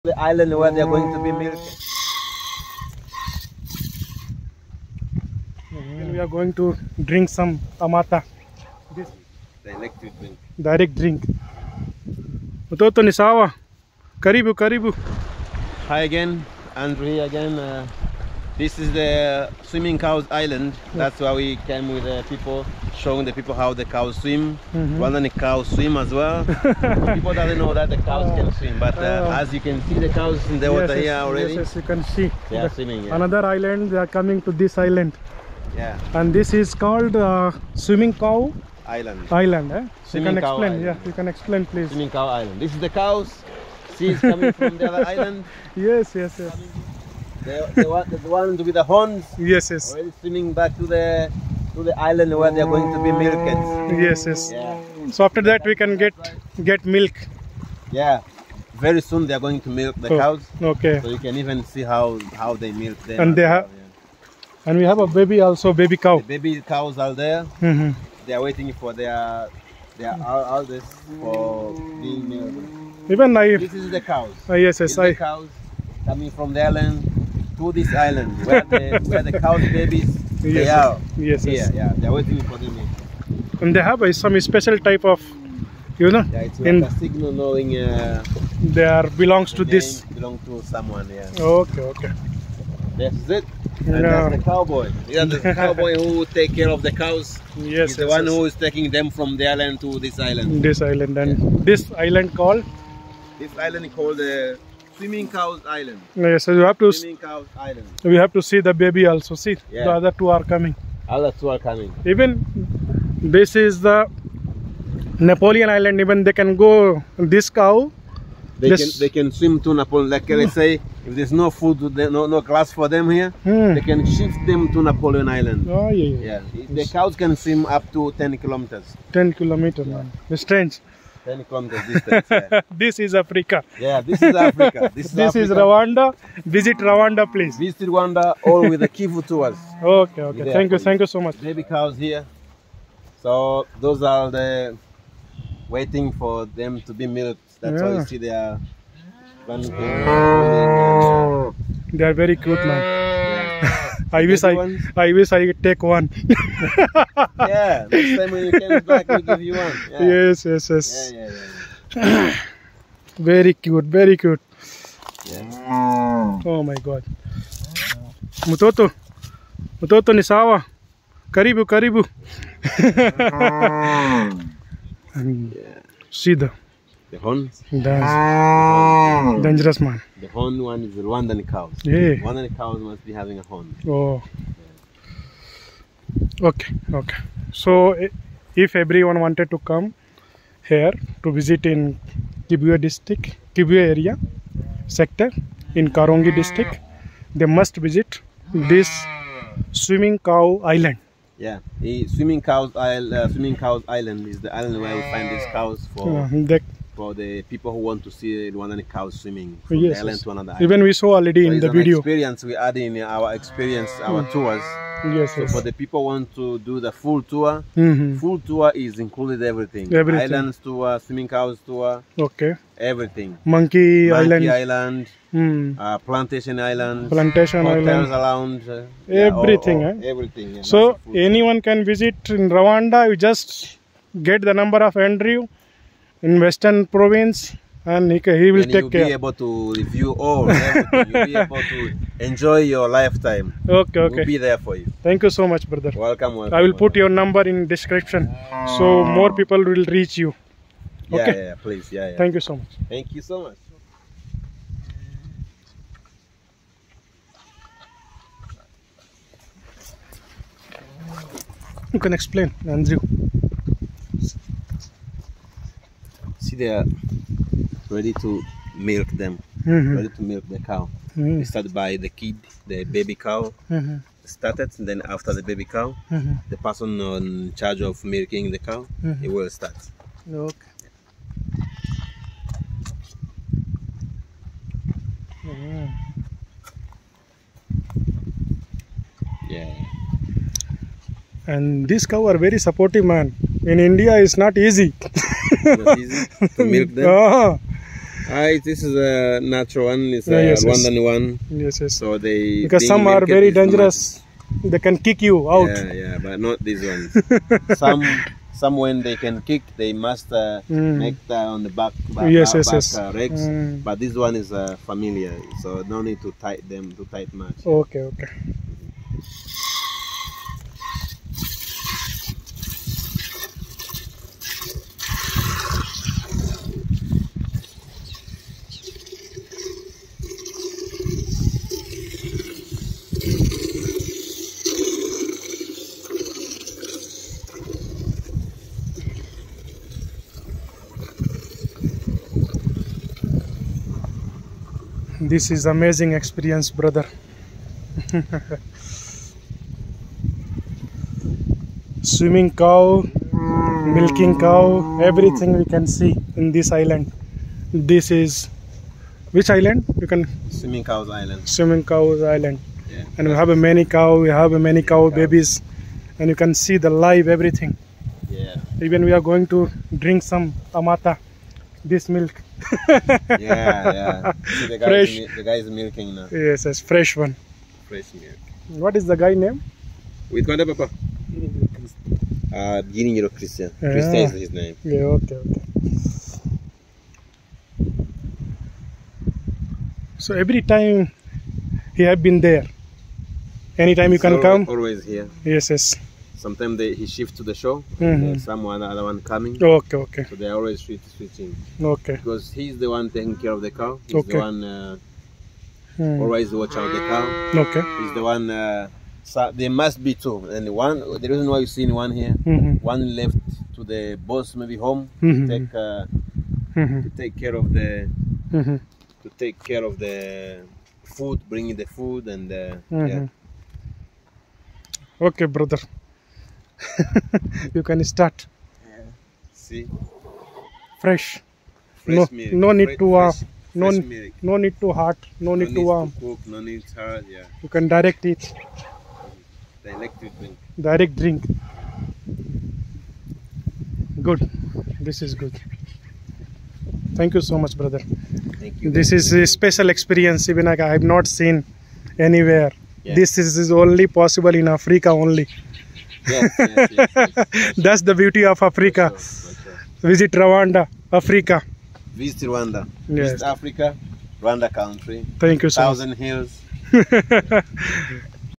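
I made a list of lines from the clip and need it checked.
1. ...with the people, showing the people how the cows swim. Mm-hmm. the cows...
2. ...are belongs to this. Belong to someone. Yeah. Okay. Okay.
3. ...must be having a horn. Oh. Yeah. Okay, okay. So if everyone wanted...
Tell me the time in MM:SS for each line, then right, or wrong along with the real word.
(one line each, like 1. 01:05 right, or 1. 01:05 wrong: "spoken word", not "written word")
1. 00:21 right
2. 01:28 right
3. 03:02 right.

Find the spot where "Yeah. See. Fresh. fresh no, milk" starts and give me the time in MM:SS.
07:08.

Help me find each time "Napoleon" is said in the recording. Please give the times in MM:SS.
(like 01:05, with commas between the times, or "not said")
01:55, 01:59, 02:04.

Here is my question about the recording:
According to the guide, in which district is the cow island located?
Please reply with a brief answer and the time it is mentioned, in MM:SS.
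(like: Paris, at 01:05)
Karongi district, at 03:15.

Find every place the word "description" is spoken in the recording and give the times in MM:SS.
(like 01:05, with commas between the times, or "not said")
04:07.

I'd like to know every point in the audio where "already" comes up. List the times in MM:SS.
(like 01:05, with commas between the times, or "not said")
00:31, 00:49, 03:31.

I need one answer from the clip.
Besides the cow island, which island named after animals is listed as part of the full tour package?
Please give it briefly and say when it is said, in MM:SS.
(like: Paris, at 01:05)
Monkey Island, at 03:44.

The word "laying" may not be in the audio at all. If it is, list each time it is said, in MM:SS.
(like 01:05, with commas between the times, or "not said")
not said.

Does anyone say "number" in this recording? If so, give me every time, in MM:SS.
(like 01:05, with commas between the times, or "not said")
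03:54, 04:07.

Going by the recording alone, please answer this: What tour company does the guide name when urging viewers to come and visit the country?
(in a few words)
Kivu tours.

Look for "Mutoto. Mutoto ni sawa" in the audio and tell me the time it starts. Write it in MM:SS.
02:48.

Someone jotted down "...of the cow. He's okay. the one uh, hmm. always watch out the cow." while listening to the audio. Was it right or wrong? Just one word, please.
right.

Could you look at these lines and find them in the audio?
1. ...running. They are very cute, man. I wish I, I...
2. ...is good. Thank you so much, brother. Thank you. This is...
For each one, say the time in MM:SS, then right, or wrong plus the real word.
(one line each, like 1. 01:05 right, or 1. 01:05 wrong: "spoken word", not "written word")
1. 02:29 right
2. 07:25 right.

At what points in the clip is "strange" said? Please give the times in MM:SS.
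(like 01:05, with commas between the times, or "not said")
02:10.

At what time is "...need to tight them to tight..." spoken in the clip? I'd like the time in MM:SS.
05:16.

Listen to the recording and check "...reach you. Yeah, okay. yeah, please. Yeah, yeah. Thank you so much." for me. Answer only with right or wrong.
right.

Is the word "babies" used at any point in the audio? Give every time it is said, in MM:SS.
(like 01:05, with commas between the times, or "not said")
01:19, 06:05.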